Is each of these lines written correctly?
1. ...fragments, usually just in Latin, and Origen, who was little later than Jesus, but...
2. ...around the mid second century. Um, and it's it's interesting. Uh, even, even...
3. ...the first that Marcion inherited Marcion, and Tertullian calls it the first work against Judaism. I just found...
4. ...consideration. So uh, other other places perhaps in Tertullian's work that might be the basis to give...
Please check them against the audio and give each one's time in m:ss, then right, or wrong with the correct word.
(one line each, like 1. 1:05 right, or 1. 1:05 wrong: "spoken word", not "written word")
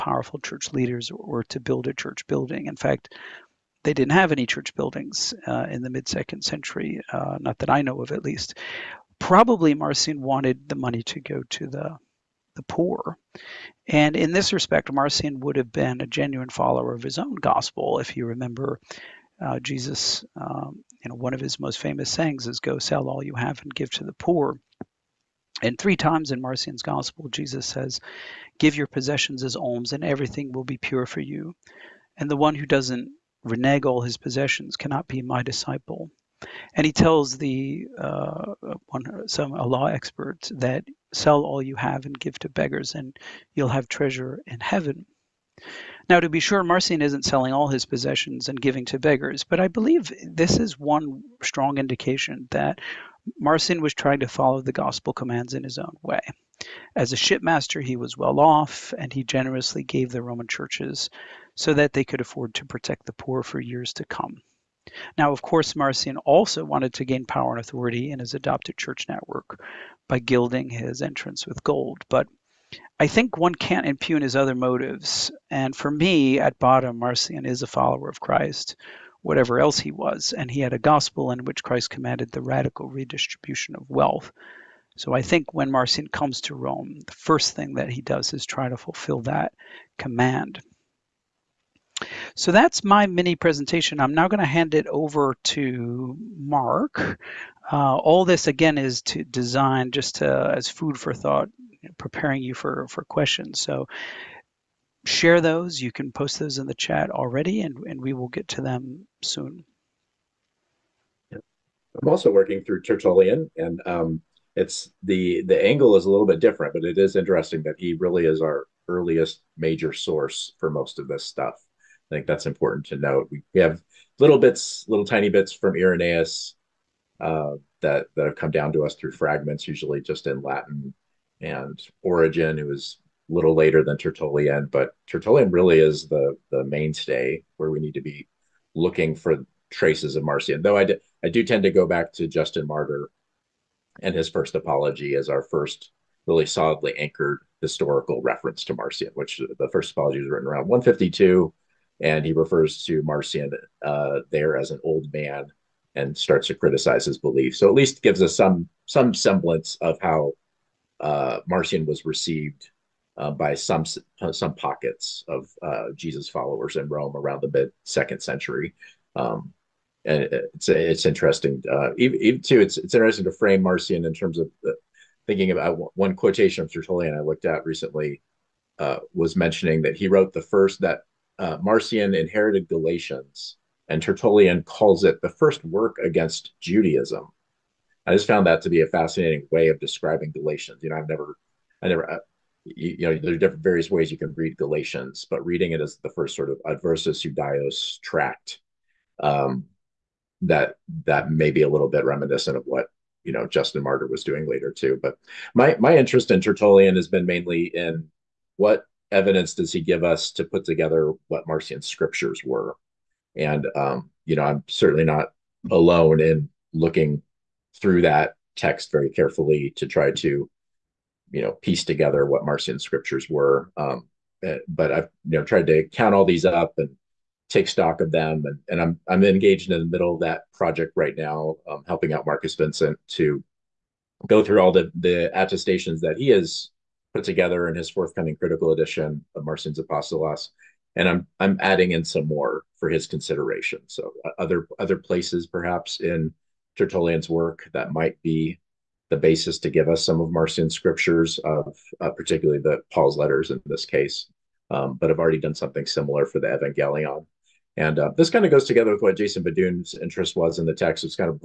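1. 2:09 wrong: "Tertullian", not "Jesus"
2. 2:47 right
3. 3:00 wrong: "Galatians", not "Marcion"
4. 4:03 right.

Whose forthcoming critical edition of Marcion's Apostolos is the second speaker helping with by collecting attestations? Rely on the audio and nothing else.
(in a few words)
Markus Vinzent.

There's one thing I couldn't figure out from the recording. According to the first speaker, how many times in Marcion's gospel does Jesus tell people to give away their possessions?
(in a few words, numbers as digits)
3.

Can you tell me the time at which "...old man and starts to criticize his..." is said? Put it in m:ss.
2:34.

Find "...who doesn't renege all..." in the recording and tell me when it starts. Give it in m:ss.
0:32.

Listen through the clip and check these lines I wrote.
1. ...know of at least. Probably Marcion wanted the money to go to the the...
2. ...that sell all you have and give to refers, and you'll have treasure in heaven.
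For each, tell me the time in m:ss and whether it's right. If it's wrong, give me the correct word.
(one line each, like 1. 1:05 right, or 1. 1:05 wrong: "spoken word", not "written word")
1. 0:07 right
2. 0:40 wrong: "beggars", not "refers".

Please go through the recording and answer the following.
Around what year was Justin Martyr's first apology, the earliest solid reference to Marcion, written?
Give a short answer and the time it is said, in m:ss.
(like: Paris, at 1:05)
152, at 2:30.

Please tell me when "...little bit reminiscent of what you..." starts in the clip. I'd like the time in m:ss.
3:21.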